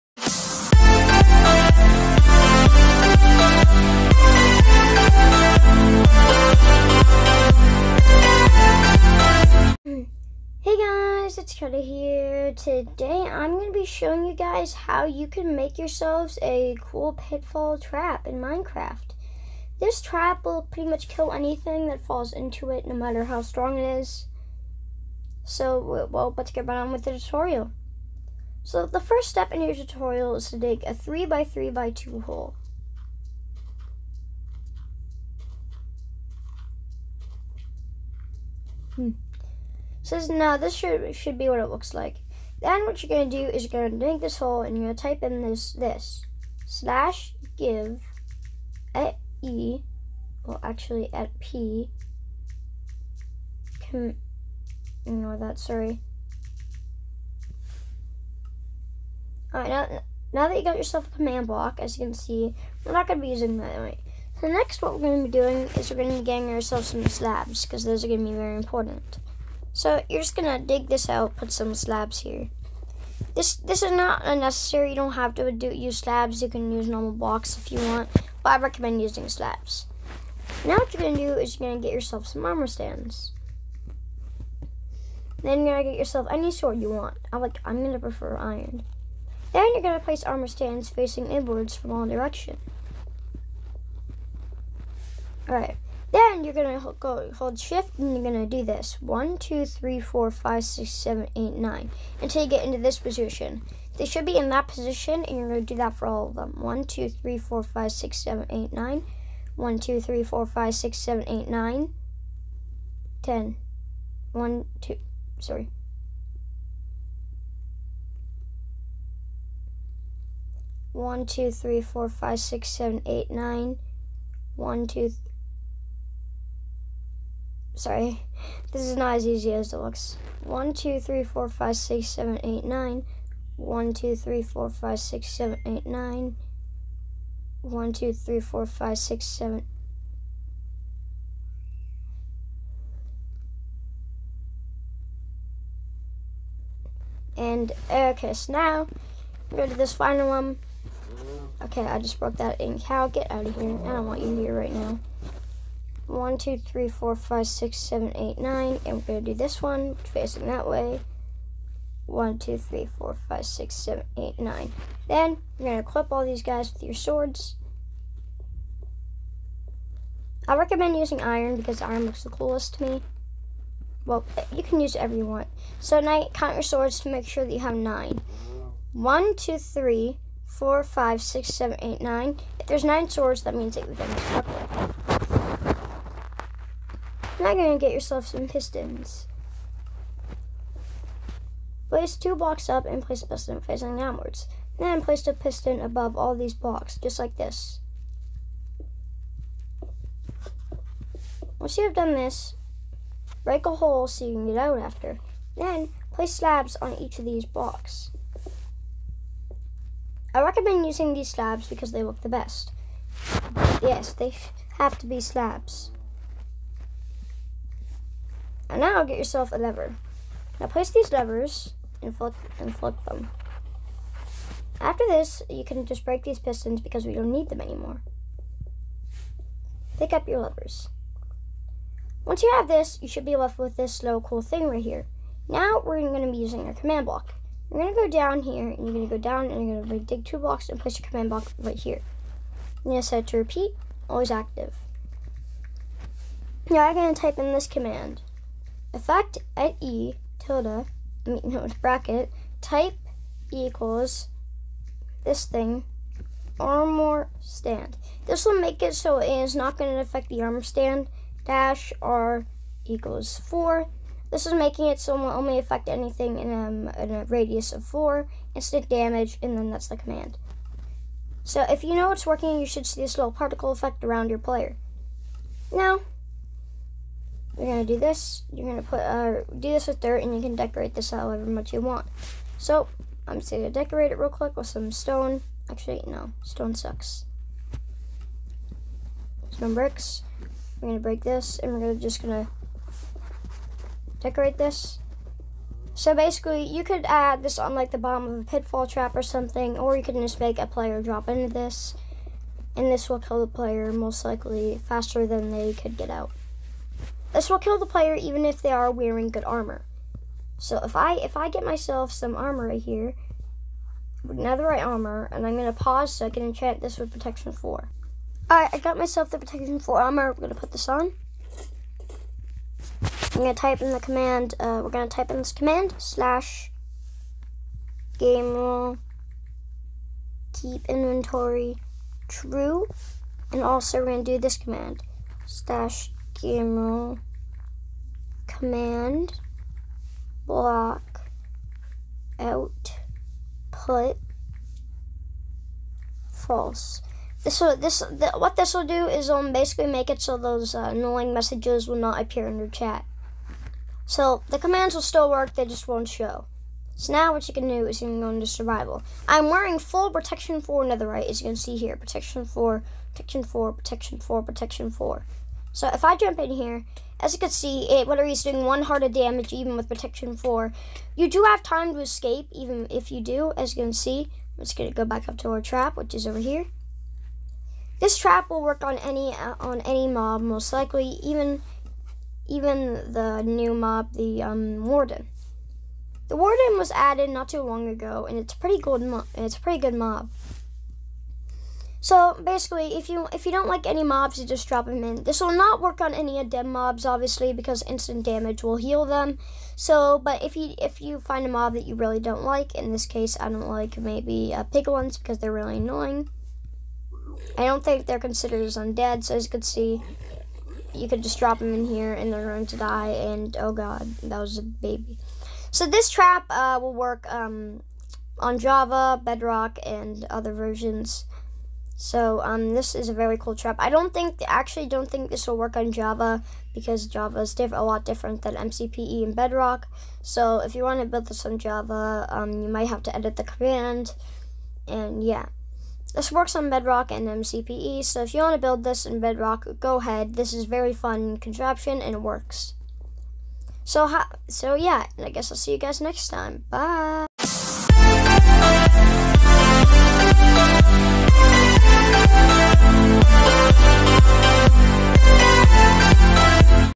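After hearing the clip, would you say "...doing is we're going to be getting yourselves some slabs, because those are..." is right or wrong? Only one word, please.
wrong.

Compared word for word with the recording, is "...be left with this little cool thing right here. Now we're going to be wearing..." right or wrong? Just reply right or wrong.
wrong.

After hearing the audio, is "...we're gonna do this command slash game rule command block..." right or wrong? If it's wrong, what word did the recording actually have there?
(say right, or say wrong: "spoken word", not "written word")
right.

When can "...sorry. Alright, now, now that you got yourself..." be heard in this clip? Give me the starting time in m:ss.
0:55.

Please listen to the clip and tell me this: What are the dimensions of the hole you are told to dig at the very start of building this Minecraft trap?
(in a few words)
3x3x2.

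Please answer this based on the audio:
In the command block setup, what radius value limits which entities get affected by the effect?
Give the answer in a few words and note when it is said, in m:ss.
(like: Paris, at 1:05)
4, at 4:21.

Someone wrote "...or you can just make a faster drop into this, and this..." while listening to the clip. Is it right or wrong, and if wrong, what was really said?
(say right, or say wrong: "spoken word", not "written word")
wrong: "player", not "faster".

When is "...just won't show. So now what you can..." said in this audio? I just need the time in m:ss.
5:55.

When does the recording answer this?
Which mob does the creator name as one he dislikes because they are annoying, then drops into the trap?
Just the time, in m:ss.
6:44.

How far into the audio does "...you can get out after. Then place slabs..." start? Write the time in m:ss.
3:24.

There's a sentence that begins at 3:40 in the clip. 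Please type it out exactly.
Now place these levers and flip, and flip them.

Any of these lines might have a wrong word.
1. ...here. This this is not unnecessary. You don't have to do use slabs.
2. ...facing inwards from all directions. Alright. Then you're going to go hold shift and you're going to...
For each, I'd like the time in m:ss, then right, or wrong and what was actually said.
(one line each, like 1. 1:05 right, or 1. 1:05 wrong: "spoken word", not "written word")
1. 1:12 right
2. 1:30 right.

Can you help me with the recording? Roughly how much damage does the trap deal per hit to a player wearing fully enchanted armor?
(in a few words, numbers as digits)
One heart.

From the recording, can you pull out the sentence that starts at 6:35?
This will not work on any of them mobs, obviously, because instant damage will heal them.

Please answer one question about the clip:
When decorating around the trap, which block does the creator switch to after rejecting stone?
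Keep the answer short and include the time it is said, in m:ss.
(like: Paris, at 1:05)
Bricks, at 4:49.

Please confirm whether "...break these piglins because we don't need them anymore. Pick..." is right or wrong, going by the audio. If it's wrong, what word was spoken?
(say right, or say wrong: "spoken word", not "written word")
wrong: "pistons", not "piglins".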